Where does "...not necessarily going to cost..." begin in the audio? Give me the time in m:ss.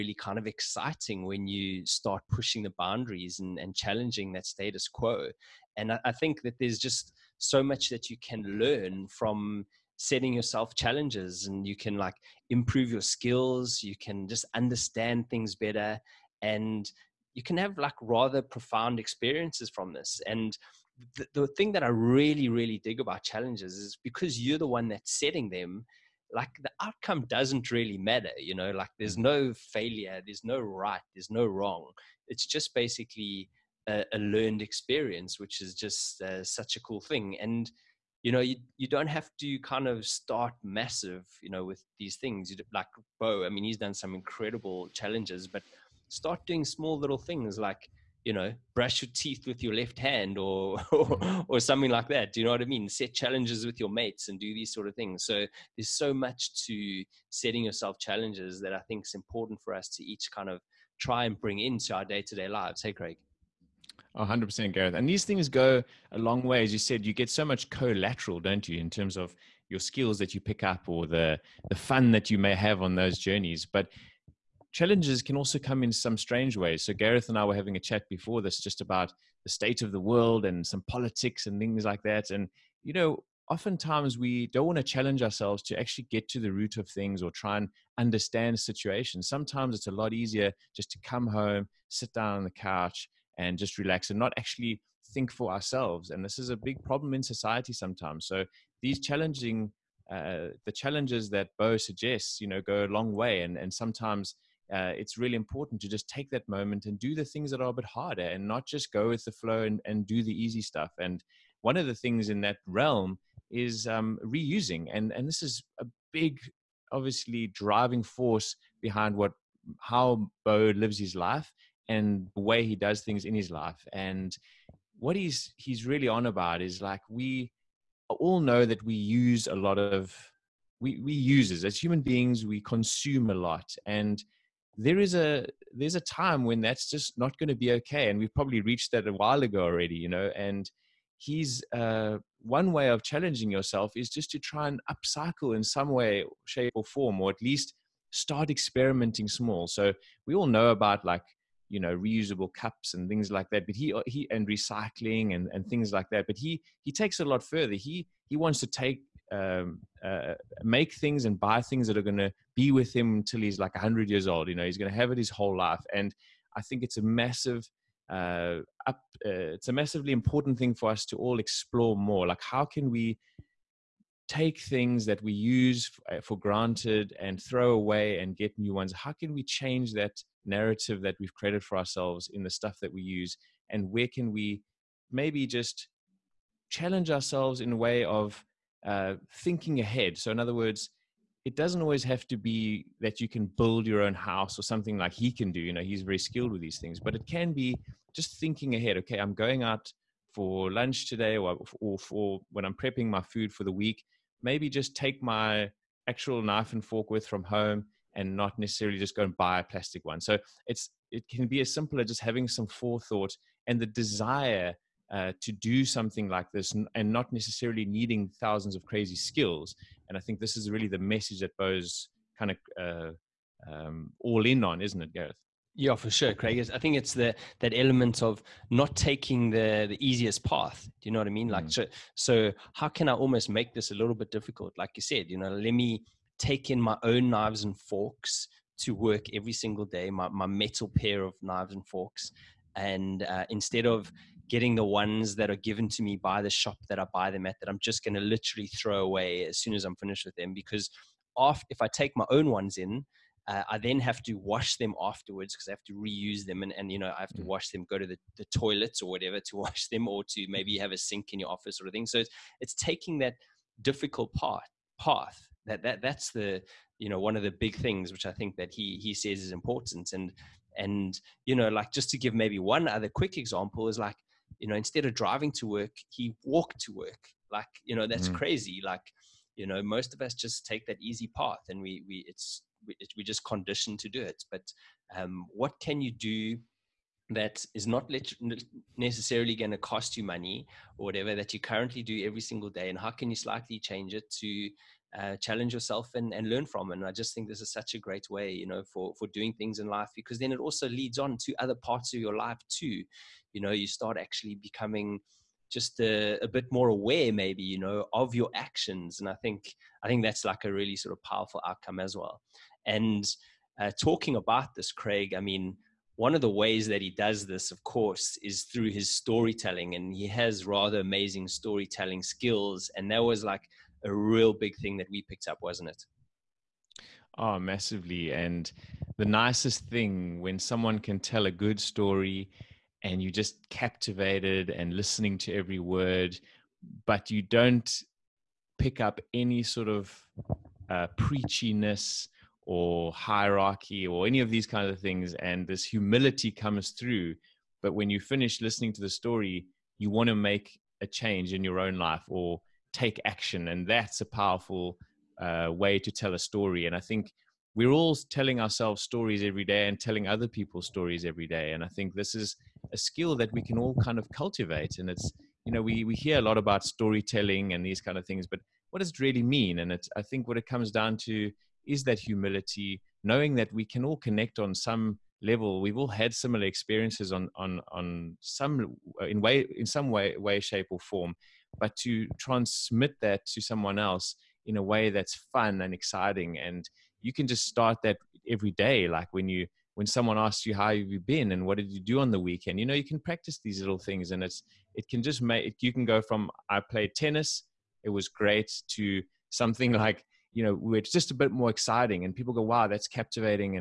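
4:47.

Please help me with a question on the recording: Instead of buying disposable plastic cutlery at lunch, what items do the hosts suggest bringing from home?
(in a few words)
Knife and fork.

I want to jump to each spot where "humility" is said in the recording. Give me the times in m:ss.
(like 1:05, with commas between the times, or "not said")
5:45, 6:12.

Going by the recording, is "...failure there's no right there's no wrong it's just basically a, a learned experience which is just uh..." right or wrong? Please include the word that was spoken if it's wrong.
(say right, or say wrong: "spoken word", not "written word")
right.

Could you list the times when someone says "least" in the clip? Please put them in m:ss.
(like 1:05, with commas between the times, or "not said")
2:27.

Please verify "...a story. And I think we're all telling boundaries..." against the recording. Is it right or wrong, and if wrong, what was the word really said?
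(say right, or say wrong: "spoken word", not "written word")
wrong: "ourselves", not "boundaries".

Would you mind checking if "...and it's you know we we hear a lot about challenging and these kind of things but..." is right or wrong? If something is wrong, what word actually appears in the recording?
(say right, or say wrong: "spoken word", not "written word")
wrong: "storytelling", not "challenging".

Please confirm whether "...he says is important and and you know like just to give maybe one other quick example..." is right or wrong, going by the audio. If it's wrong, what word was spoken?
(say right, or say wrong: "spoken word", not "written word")
right.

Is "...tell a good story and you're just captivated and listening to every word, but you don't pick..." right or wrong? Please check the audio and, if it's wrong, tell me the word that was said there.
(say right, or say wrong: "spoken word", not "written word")
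right.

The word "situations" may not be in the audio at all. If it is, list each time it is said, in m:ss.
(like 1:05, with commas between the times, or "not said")
1:28.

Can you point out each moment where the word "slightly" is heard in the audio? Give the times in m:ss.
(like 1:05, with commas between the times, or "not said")
4:53.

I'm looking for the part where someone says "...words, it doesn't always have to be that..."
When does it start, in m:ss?
3:10.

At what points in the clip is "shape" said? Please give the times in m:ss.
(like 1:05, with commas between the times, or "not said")
2:26, 6:20.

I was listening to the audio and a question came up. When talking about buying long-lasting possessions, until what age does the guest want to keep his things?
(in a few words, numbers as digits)
100.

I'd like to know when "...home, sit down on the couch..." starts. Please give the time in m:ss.
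1:31.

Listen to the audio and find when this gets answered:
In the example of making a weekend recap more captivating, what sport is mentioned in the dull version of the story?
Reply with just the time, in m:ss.
6:37.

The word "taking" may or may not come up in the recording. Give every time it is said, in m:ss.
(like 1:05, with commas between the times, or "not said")
3:48, 4:22.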